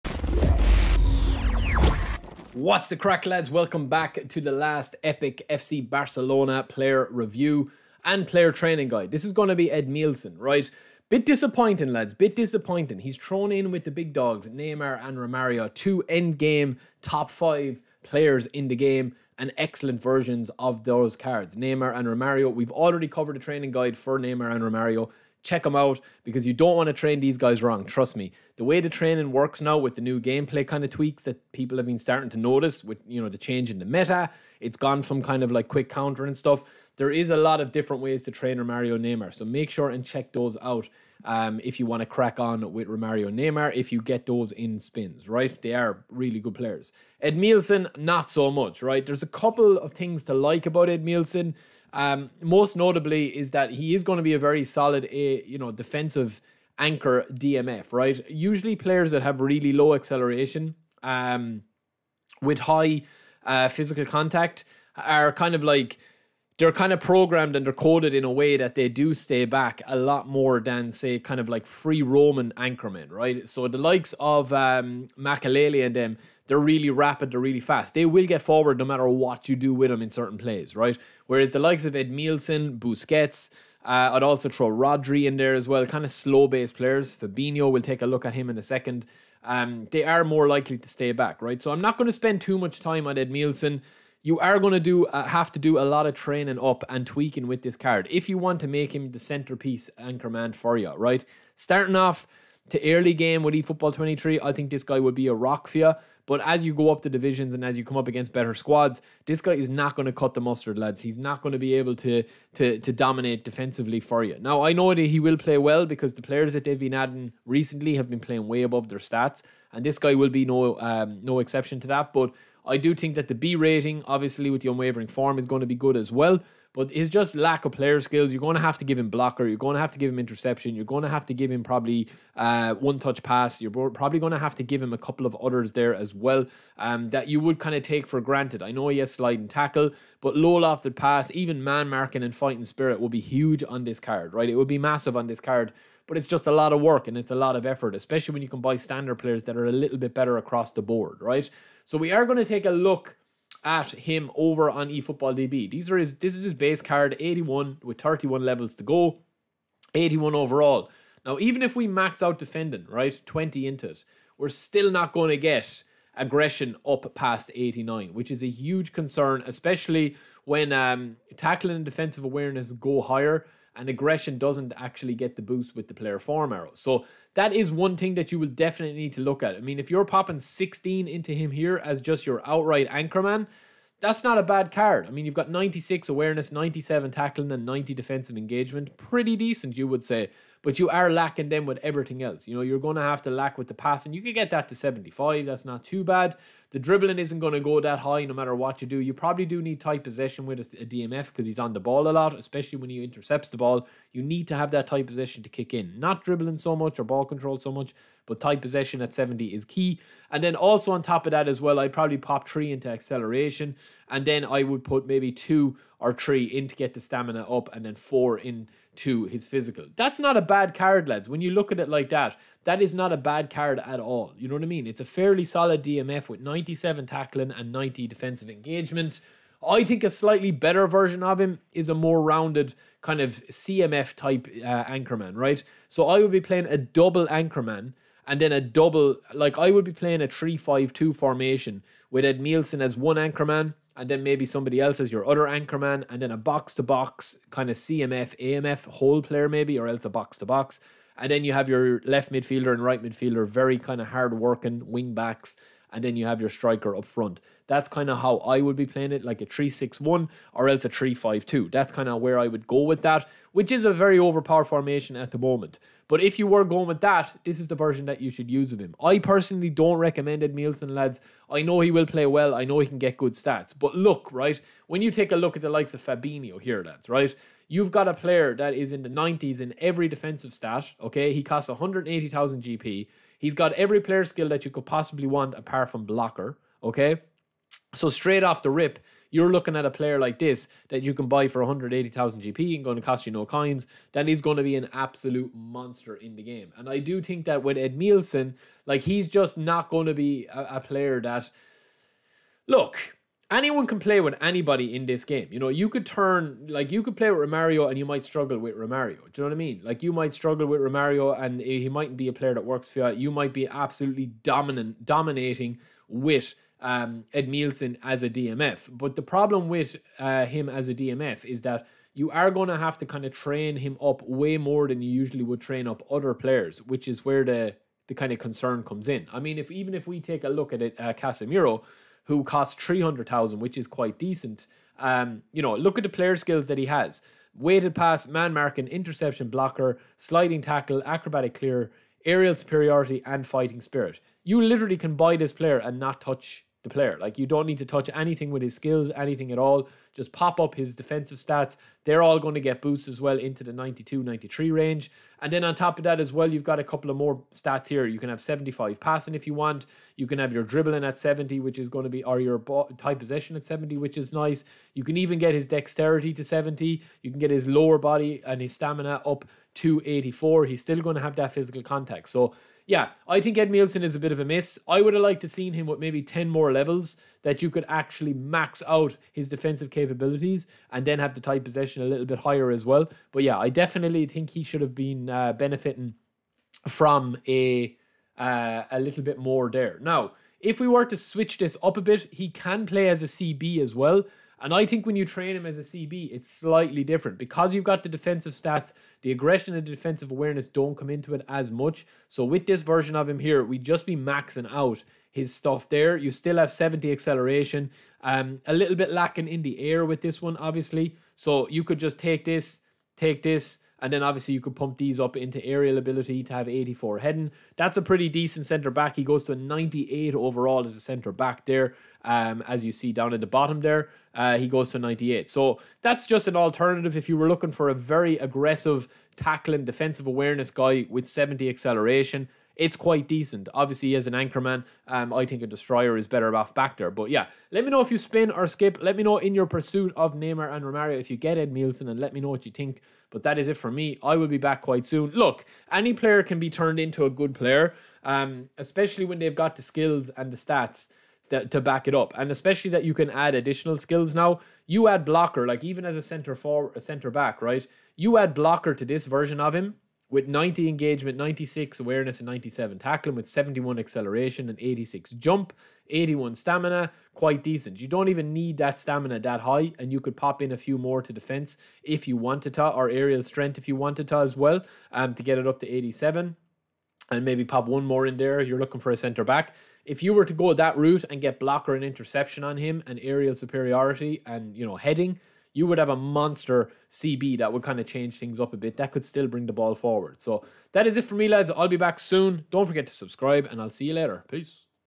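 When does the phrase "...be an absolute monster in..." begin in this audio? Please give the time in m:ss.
4:54.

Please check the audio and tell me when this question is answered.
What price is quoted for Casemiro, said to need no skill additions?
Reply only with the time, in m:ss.
5:32.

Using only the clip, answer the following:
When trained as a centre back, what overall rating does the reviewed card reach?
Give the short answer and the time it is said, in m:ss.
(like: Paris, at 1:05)
98, at 6:59.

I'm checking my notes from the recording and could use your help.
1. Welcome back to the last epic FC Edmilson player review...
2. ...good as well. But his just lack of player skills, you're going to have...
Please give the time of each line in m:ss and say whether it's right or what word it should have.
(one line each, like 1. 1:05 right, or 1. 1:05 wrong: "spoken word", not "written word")
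1. 0:03 wrong: "Barcelona", not "Edmilson"
2. 2:05 right.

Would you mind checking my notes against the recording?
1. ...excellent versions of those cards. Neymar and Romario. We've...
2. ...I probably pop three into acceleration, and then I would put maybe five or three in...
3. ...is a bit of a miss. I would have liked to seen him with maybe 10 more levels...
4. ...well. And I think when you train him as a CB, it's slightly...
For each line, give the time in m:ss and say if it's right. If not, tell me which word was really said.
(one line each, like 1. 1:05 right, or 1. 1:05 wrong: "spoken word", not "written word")
1. 0:19 right
2. 3:31 wrong: "two", not "five"
3. 6:14 right
4. 6:33 right.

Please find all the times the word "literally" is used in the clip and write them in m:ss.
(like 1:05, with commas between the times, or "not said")
5:44.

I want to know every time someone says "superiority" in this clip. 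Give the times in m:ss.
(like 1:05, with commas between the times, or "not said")
5:42, 8:03.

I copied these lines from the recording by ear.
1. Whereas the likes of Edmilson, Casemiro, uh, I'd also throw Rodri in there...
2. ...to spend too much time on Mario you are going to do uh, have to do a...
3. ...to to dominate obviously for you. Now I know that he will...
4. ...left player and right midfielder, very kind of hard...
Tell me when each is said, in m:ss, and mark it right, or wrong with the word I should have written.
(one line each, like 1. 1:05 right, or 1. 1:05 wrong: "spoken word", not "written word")
1. 1:21 wrong: "Busquets", not "Casemiro"
2. 1:32 wrong: "Edmilson", not "Mario"
3. 1:52 wrong: "defensively", not "obviously"
4. 4:12 wrong: "midfielder", not "player".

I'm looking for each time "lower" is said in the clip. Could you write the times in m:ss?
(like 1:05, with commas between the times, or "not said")
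6:07.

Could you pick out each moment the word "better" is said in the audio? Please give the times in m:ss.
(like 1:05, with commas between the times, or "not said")
1:48, 2:30, 3:50, 7:16.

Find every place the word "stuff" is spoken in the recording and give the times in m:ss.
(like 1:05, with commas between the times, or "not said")
0:36, 6:45.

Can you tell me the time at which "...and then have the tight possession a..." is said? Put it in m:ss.
6:20.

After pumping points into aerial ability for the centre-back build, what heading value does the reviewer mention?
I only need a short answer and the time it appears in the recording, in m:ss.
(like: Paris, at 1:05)
84, at 6:56.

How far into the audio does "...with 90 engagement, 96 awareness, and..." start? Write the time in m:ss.
7:40.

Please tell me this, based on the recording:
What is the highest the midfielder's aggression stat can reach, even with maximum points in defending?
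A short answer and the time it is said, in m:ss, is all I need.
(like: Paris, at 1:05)
89, at 2:47.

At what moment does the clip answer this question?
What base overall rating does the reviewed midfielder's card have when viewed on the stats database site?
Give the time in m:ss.
2:39.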